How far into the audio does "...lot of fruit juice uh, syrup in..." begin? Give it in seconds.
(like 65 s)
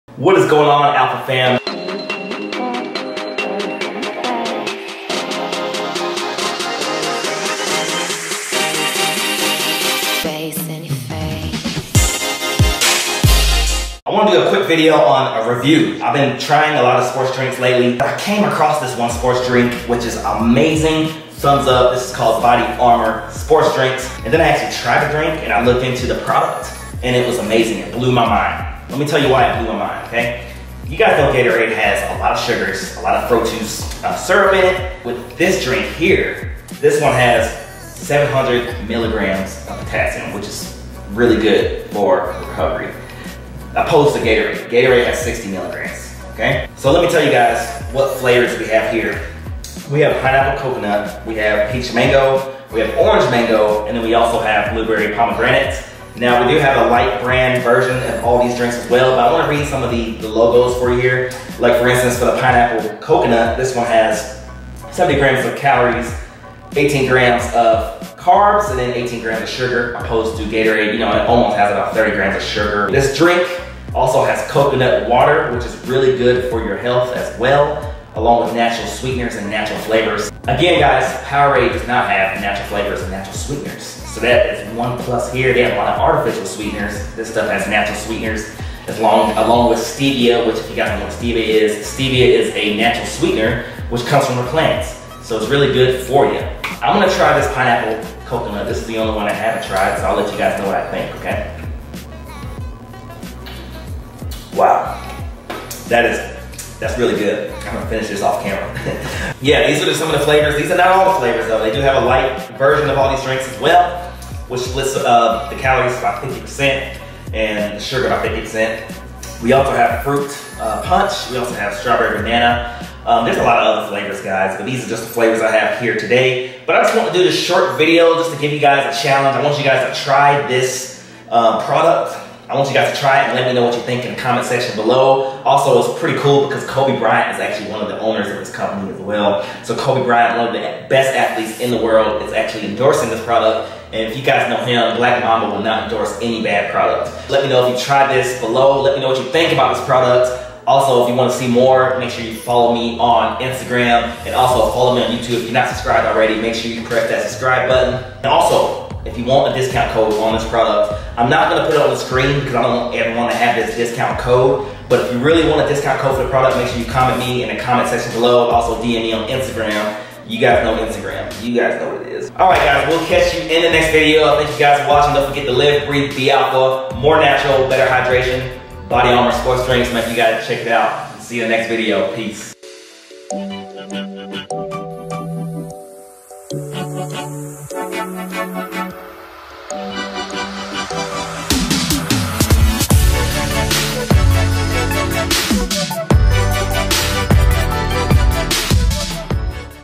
32 s.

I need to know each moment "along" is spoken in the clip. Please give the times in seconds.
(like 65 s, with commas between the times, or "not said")
78 s, 89 s.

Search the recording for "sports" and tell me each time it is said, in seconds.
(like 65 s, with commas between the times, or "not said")
179 s.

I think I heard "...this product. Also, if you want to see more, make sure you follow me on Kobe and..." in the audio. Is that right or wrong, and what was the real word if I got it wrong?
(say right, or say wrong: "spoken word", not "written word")
wrong: "Instagram", not "Kobe".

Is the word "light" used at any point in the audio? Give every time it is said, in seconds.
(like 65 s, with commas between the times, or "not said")
56 s, 112 s.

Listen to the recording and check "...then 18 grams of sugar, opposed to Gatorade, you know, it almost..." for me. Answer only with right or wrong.
right.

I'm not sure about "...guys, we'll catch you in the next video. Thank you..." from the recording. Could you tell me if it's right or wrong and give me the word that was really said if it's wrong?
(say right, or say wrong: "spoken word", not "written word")
right.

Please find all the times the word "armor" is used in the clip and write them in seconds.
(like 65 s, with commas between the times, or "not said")
179 s.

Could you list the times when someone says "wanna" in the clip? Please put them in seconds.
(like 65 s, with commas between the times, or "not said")
59 s, 163 s.